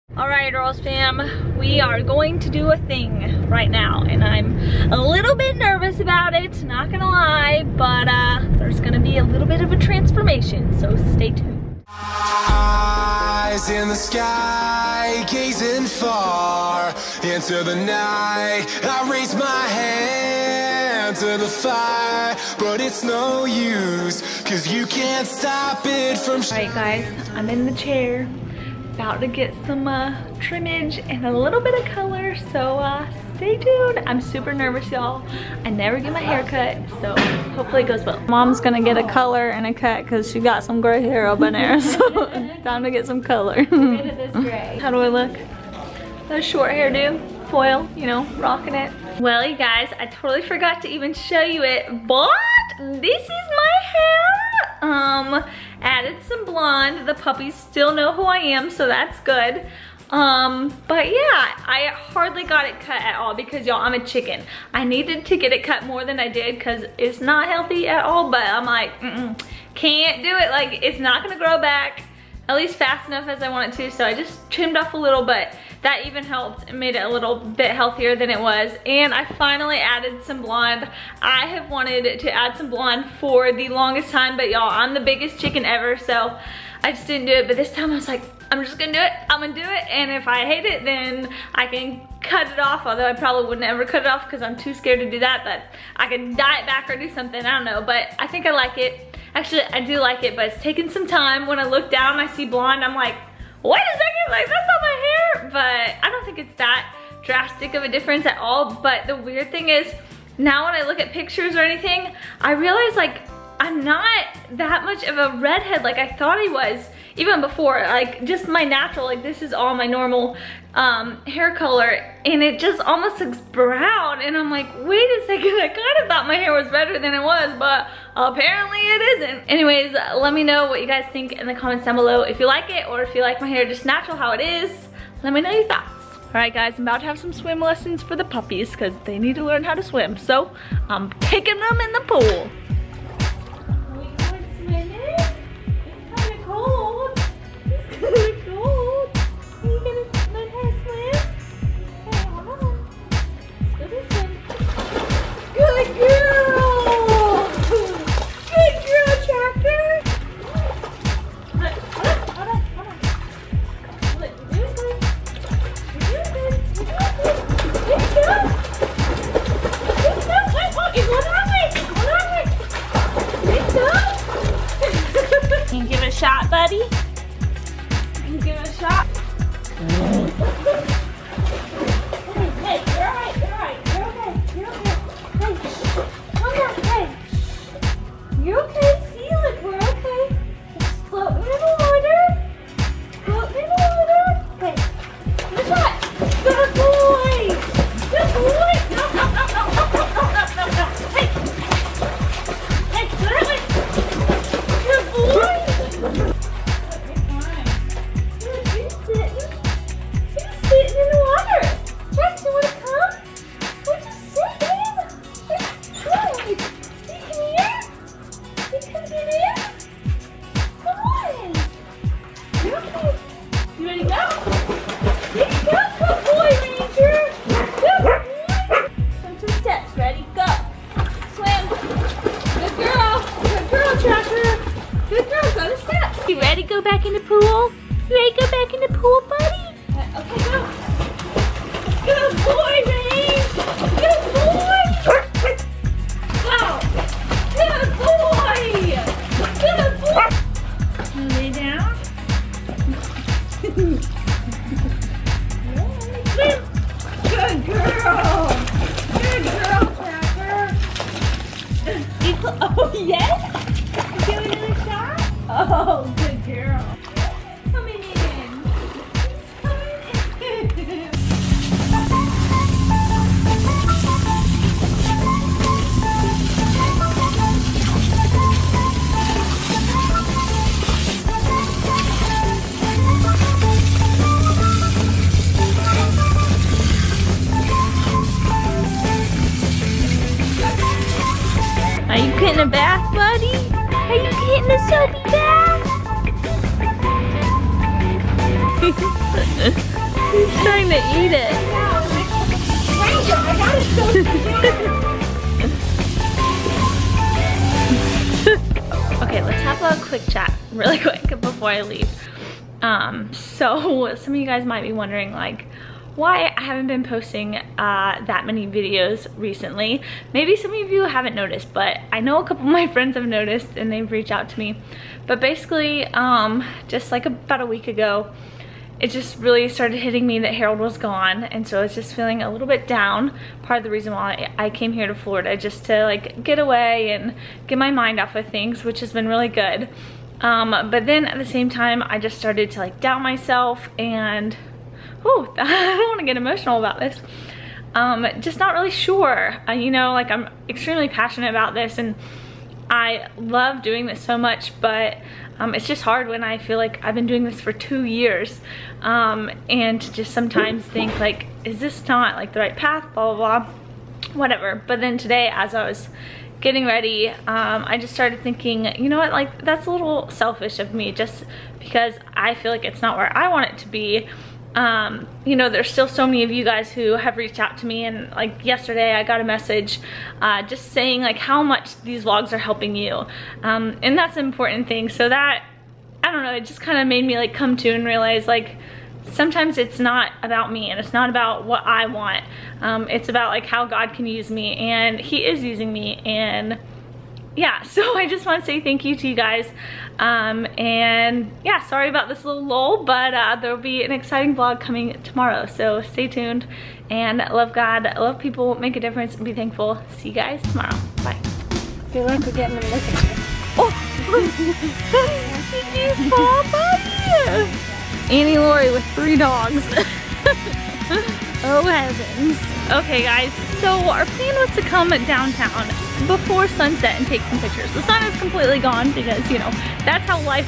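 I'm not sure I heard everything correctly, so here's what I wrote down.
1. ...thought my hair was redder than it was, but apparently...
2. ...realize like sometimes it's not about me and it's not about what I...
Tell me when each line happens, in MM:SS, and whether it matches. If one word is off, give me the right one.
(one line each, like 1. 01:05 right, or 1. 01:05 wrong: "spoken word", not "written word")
1. 02:06 right
2. 06:28 right.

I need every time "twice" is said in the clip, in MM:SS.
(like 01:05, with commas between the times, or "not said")
not said.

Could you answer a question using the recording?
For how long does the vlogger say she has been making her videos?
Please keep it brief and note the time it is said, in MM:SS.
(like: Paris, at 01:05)
2 years, at 05:57.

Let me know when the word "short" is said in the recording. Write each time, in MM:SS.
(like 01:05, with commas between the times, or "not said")
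00:46.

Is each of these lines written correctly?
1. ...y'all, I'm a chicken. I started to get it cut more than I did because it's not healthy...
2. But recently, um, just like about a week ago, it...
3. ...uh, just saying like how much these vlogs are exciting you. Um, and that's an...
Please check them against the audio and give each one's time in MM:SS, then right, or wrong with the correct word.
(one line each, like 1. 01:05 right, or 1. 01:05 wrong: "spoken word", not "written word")
1. 01:03 wrong: "needed", not "started"
2. 05:25 wrong: "basically", not "recently"
3. 06:20 wrong: "helping", not "exciting".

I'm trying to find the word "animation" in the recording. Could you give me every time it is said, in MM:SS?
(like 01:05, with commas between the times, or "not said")
not said.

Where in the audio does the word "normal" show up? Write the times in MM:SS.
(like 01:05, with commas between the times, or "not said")
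01:59.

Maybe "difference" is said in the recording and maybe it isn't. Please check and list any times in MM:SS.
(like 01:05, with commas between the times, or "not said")
01:47, 06:48.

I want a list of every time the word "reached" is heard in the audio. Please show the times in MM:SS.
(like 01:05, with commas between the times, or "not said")
05:24, 06:17.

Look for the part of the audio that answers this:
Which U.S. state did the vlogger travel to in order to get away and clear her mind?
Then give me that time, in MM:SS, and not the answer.
05:35.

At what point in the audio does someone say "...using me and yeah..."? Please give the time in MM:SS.
06:35.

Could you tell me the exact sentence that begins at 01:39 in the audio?
Actually, I do like it, but it's taken some time.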